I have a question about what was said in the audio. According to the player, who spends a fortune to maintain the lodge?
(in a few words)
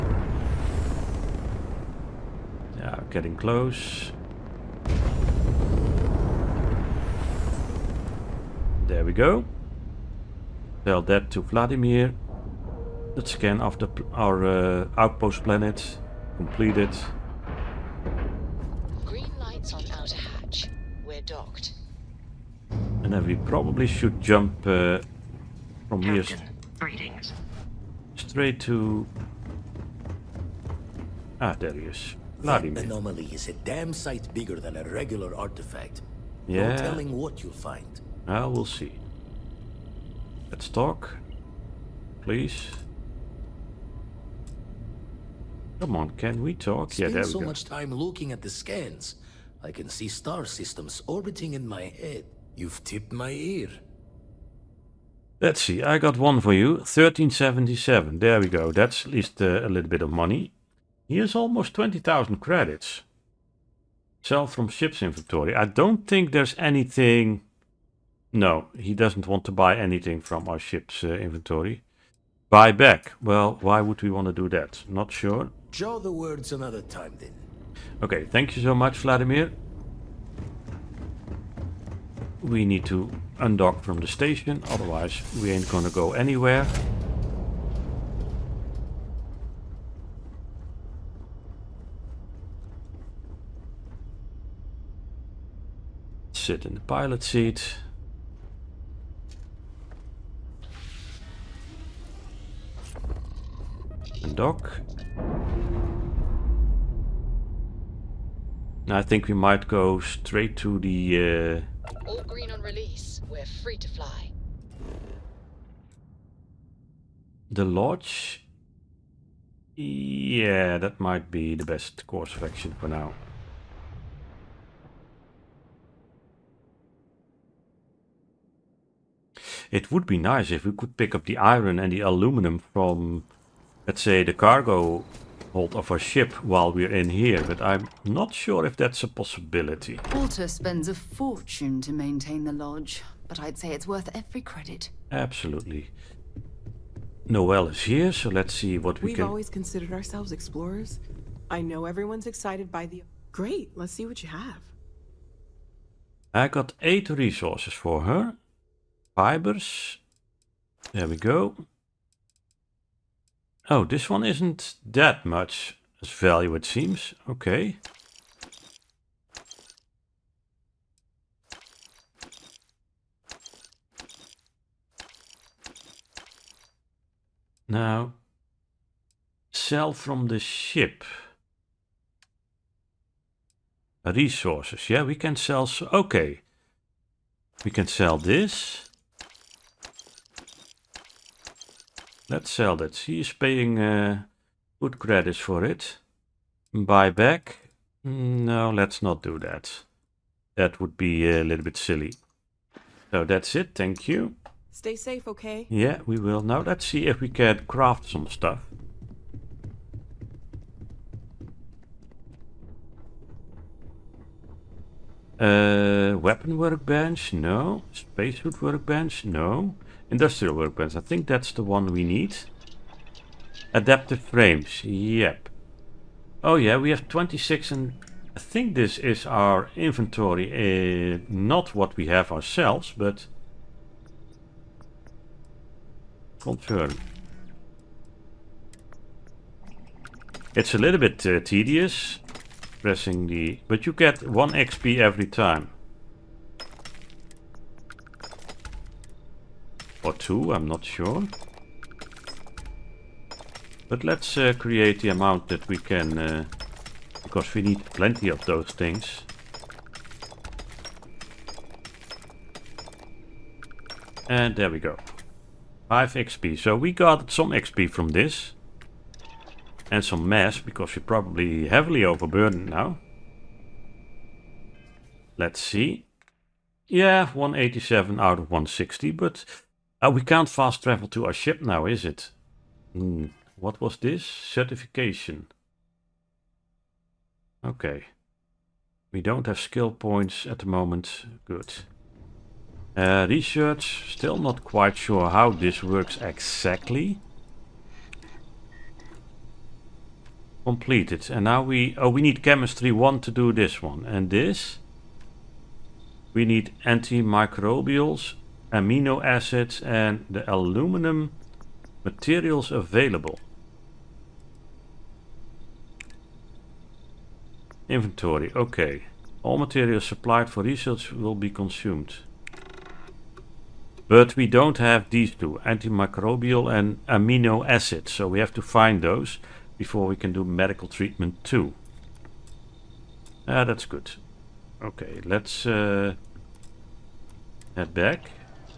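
Walter.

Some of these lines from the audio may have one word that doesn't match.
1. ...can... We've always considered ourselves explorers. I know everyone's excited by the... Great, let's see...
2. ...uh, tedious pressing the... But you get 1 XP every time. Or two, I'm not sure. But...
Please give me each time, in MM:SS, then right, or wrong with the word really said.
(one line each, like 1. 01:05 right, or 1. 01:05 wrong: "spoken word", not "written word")
1. 02:29 right
2. 04:01 right.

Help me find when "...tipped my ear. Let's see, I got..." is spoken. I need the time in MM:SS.
00:52.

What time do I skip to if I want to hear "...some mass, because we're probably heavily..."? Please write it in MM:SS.
04:30.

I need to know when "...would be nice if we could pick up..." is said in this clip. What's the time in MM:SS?
02:09.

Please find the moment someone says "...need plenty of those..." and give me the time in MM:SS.
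04:17.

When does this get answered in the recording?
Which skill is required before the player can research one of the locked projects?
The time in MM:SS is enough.
05:02.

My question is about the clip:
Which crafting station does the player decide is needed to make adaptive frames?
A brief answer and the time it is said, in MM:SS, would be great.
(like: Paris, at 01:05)
Industrial workbench, at 03:40.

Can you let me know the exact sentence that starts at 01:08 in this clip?
No, he doesn't want to buy anything from our ship's uh, inventory.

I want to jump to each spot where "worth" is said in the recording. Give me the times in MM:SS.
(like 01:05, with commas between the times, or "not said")
02:23.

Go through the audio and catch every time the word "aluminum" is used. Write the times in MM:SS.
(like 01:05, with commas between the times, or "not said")
02:12, 05:10.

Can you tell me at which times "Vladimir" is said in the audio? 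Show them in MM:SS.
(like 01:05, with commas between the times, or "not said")
00:11, 01:18.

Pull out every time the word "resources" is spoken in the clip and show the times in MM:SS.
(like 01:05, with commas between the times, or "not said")
02:37, 03:04.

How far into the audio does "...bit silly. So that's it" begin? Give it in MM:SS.
03:21.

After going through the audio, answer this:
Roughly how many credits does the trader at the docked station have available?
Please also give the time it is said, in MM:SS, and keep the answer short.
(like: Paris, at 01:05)
20,000, at 01:01.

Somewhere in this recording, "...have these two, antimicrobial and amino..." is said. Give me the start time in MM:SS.
05:24.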